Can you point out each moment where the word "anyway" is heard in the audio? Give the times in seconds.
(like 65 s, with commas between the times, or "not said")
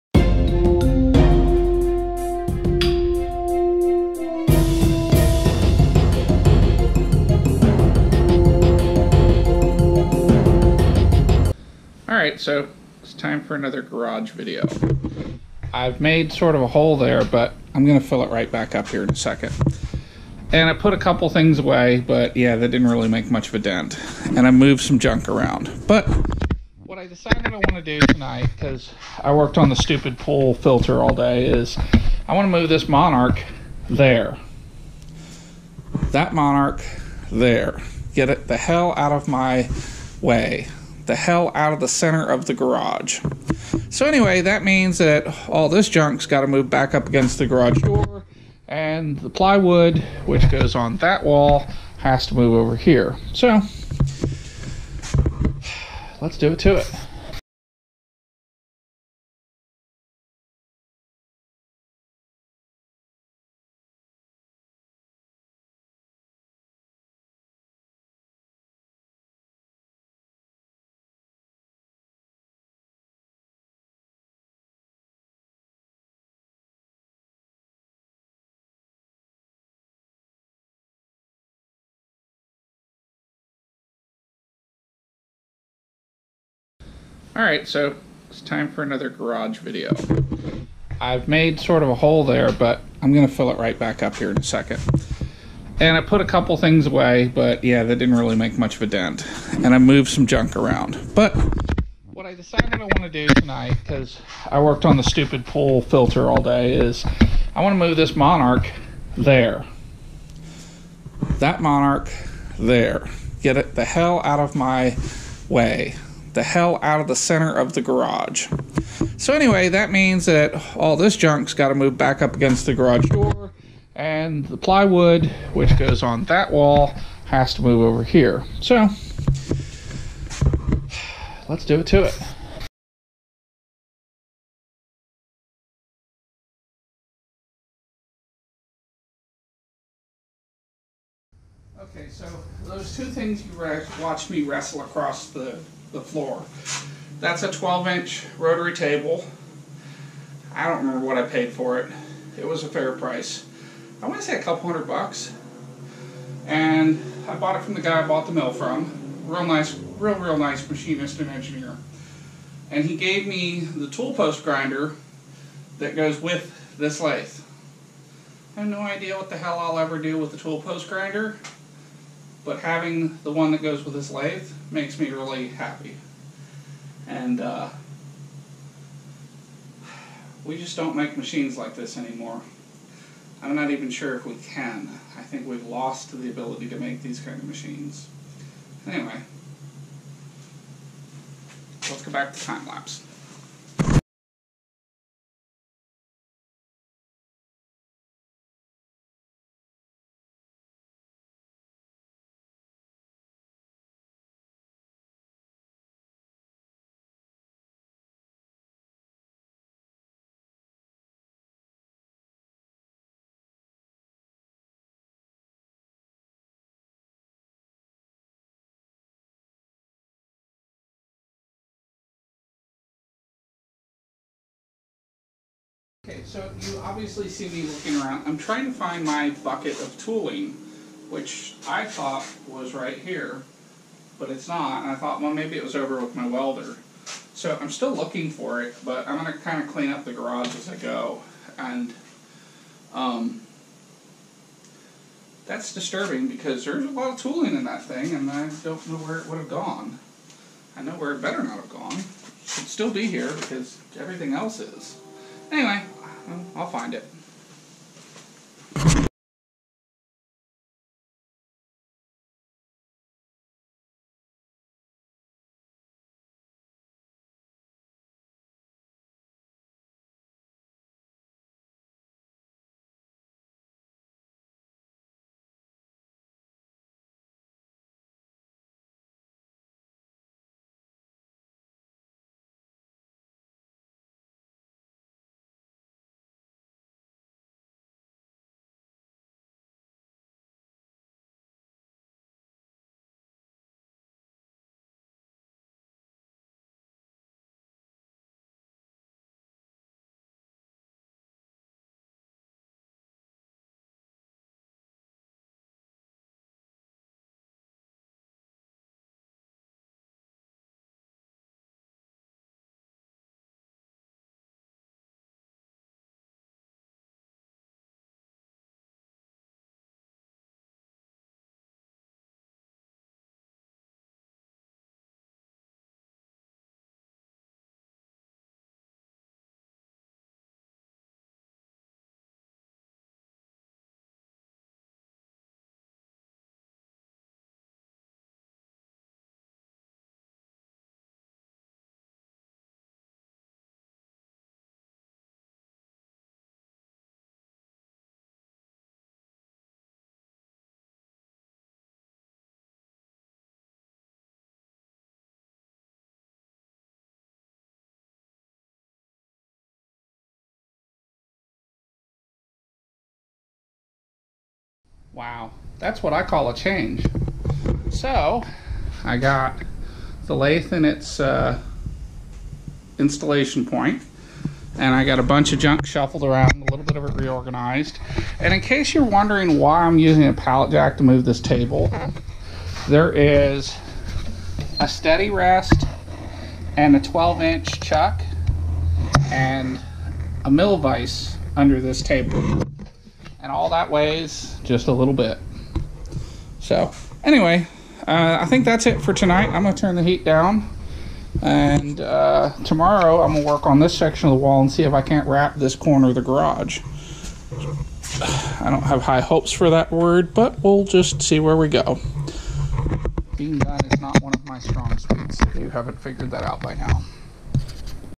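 44 s, 119 s, 188 s, 255 s, 397 s.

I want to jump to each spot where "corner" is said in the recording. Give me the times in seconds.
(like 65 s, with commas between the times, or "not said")
405 s.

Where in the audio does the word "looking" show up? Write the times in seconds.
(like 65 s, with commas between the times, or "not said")
227 s, 237 s.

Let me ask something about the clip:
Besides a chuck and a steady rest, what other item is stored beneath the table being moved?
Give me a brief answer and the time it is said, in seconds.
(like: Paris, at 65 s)
mill vise, at 390 s.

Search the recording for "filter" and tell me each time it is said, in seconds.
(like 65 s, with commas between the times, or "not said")
30 s, 105 s.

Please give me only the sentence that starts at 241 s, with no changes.
And um, that's disturbing because there's a lot of tooling in that thing, and I don't know where it would have gone.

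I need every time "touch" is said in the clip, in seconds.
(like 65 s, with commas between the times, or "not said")
not said.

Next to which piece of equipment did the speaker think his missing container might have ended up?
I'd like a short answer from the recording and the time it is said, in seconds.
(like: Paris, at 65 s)
welder, at 236 s.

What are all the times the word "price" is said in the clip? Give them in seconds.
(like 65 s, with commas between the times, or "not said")
152 s.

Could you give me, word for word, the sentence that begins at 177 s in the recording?
And uh, we just don't make machines like this anymore.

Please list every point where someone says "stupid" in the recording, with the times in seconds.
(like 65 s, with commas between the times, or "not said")
29 s, 105 s.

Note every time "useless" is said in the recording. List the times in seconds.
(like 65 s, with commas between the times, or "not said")
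not said.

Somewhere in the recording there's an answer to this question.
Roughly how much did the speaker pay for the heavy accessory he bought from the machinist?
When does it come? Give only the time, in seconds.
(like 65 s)
154 s.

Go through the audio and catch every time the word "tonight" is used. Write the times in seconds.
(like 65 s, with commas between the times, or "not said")
28 s, 103 s, 399 s.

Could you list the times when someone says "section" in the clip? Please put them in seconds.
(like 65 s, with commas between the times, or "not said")
403 s.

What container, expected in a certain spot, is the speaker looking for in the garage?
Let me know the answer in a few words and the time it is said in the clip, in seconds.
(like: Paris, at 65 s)
bucket of tooling, at 229 s.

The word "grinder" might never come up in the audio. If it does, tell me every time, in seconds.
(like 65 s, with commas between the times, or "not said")
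164 s, 170 s.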